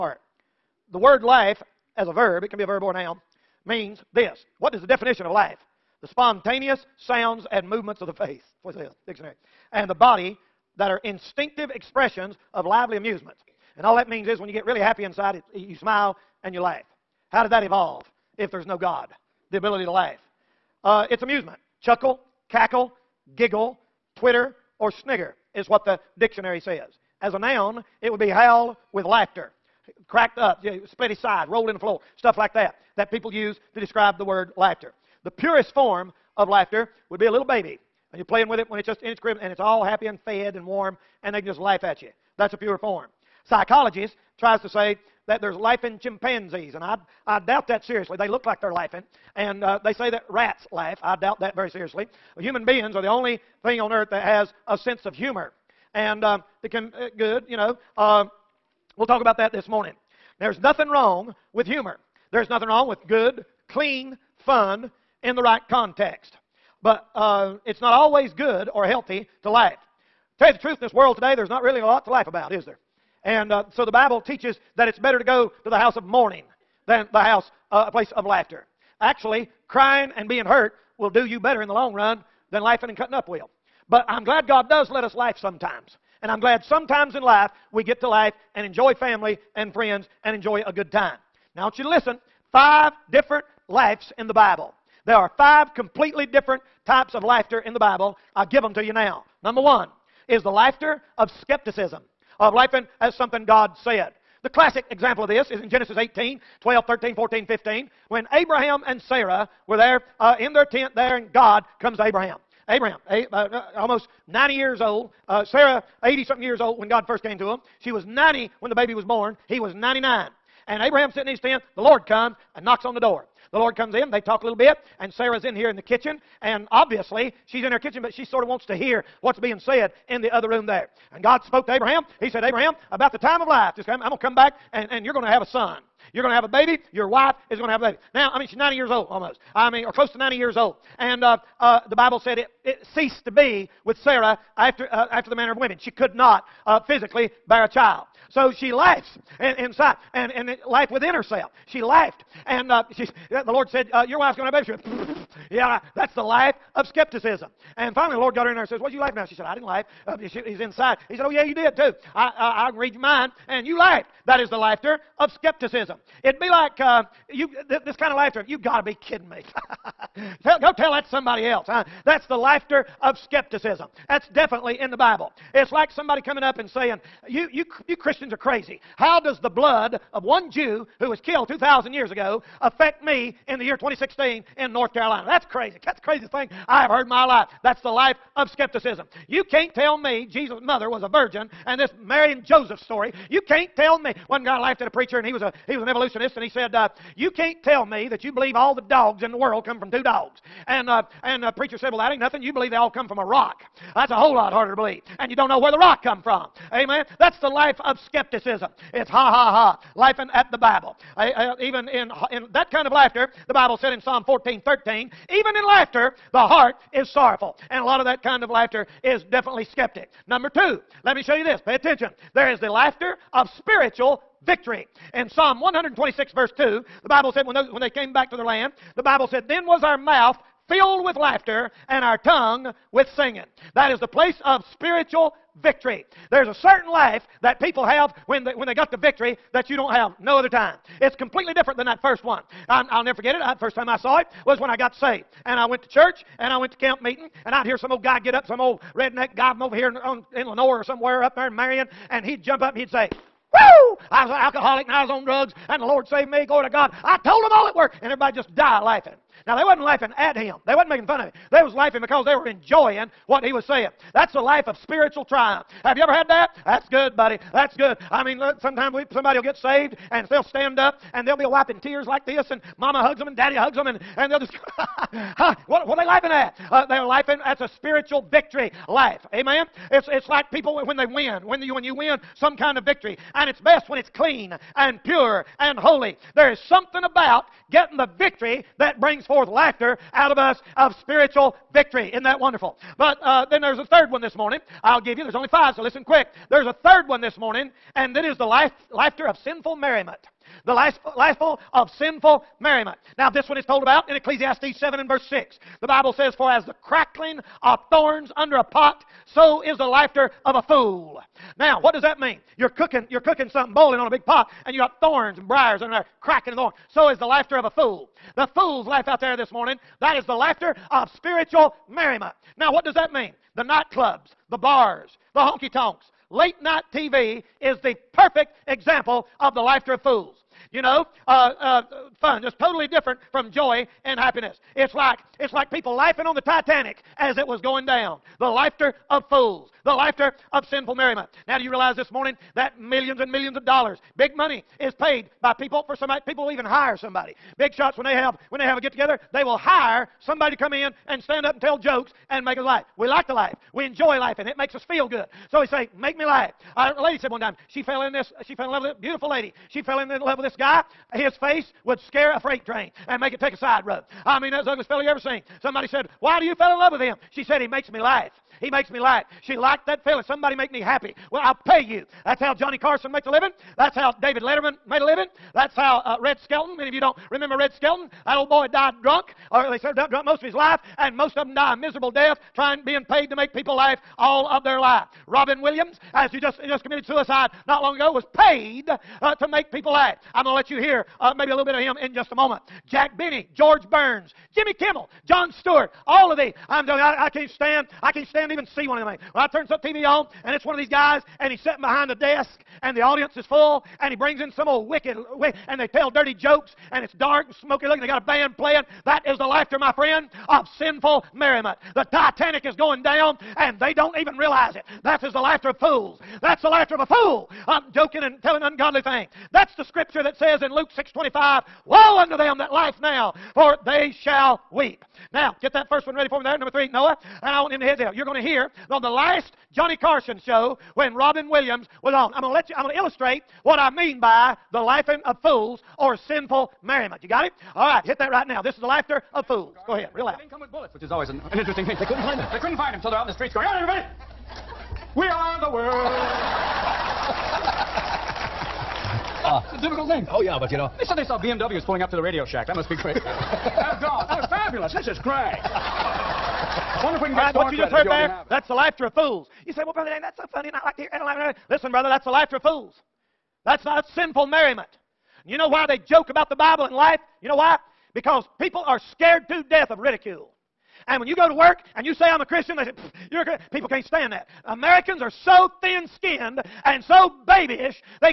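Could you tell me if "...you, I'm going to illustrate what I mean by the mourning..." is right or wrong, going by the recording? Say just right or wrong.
wrong.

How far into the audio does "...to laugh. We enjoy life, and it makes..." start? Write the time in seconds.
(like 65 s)
353 s.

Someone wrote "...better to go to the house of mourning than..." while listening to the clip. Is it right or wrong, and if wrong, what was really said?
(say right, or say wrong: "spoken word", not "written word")
right.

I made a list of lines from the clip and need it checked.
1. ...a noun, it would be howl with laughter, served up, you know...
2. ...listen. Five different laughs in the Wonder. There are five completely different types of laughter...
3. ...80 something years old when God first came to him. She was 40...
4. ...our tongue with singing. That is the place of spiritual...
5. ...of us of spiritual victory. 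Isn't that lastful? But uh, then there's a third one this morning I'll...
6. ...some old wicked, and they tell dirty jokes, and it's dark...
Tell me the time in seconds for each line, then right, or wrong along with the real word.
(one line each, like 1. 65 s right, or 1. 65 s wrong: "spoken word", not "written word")
1. 27 s wrong: "cracked", not "served"
2. 91 s wrong: "Bible", not "Wonder"
3. 116 s wrong: "90", not "40"
4. 232 s right
5. 290 s wrong: "wonderful", not "lastful"
6. 404 s right.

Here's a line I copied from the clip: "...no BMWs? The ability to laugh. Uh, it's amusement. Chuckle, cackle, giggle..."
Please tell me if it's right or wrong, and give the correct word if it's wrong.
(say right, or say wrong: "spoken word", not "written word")
wrong: "God", not "BMWs".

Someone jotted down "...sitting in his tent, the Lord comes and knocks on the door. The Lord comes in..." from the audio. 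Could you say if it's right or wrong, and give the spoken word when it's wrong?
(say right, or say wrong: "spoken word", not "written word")
right.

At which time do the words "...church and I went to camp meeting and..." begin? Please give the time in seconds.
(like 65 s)
245 s.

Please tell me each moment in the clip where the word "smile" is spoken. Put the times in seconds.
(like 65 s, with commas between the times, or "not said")
15 s.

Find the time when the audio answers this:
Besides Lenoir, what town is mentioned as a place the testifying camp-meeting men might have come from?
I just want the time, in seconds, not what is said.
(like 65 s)
251 s.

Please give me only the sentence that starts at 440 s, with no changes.
They didn't come with bullets, which is always an, an interesting thing.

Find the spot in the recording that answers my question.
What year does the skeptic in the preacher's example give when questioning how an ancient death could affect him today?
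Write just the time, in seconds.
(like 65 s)
183 s.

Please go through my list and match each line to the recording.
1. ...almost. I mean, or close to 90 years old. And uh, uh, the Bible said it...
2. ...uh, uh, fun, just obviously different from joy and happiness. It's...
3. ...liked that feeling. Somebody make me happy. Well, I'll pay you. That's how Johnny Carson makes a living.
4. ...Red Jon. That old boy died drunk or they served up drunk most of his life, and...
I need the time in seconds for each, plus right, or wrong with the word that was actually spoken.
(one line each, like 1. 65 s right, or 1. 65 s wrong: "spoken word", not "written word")
1. 139 s right
2. 331 s wrong: "totally", not "obviously"
3. 369 s right
4. 377 s wrong: "Skelton", not "Jon".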